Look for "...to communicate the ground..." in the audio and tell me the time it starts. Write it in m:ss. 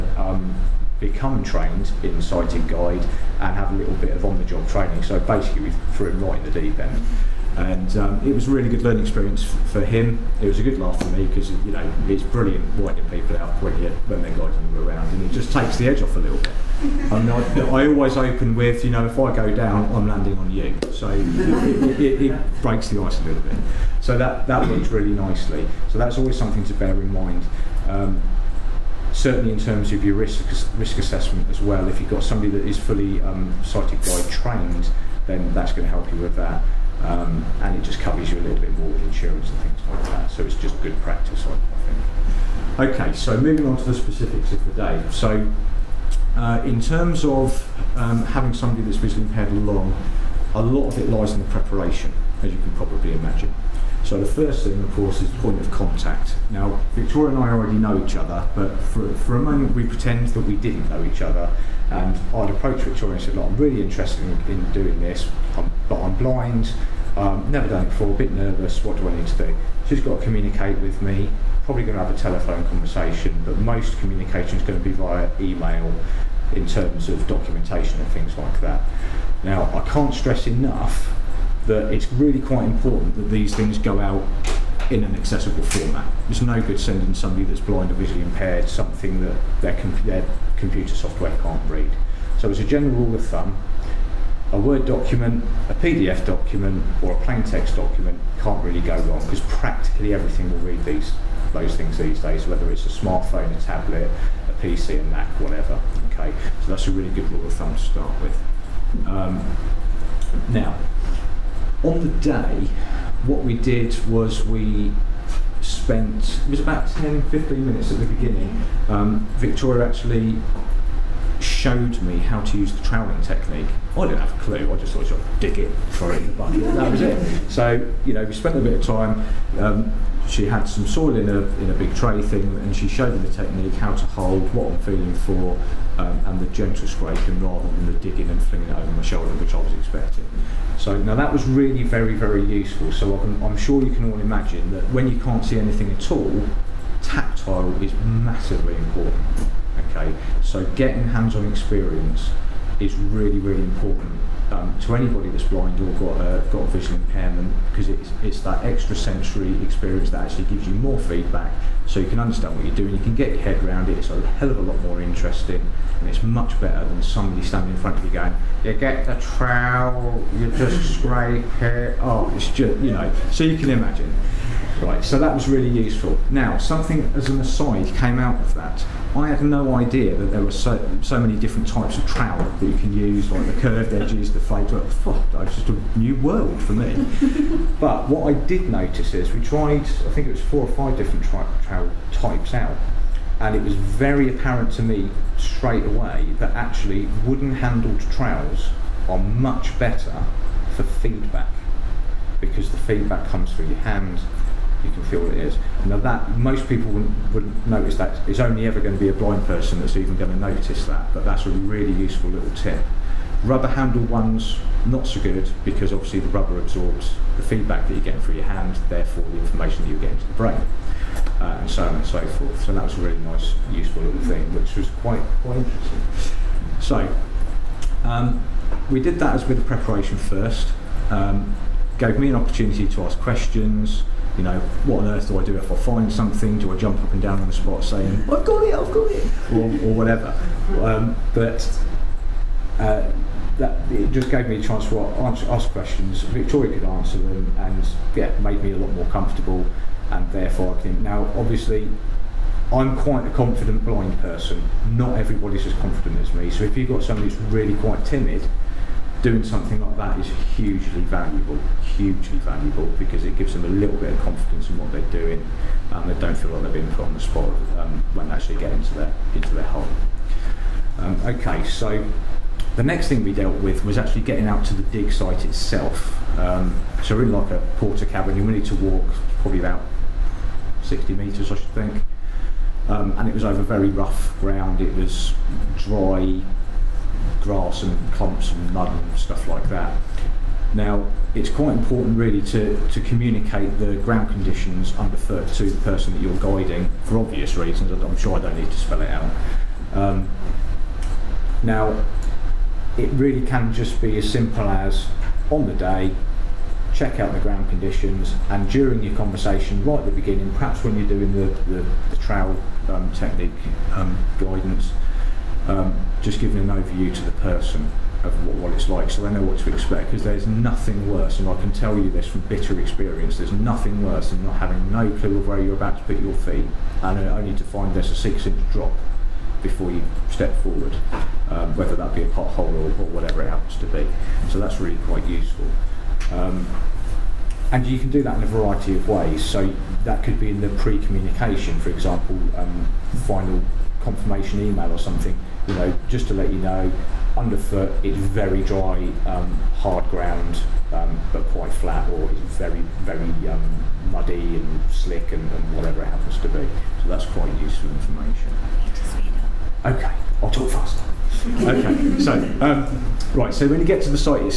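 4:52.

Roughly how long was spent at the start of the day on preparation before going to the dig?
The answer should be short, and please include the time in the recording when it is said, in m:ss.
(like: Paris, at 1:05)
10 to 15 minutes, at 1:56.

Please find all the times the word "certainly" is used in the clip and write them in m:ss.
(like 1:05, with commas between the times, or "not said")
0:29.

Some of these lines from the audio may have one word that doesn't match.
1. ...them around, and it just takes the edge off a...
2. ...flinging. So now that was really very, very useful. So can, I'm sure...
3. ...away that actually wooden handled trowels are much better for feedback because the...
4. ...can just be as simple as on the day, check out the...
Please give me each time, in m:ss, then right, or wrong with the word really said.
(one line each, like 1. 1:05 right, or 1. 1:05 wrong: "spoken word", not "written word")
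1. 0:14 right
2. 2:19 wrong: "expecting", not "flinging"
3. 3:15 right
4. 5:03 right.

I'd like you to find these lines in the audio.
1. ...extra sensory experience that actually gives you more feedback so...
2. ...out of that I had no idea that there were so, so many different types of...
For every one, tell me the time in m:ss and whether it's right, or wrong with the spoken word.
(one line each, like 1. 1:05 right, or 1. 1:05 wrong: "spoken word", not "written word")
1. 2:38 right
2. 2:58 right.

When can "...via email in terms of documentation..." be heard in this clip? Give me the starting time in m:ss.
1:14.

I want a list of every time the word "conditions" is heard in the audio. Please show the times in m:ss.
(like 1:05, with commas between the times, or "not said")
4:54, 5:07.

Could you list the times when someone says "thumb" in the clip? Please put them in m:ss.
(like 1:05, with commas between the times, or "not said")
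1:33, 1:47.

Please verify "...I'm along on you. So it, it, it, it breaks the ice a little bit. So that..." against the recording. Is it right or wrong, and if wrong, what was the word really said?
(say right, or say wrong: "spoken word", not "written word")
wrong: "landing", not "along".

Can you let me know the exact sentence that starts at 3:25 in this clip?
Now that most people wouldn't, wouldn't notice that.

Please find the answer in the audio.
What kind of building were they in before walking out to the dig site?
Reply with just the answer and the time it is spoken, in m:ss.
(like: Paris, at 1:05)
Portakabin, at 4:37.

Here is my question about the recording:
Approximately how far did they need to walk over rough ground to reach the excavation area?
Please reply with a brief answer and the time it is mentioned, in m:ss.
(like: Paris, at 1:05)
60 metres, at 4:40.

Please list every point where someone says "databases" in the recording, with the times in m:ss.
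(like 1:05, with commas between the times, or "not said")
not said.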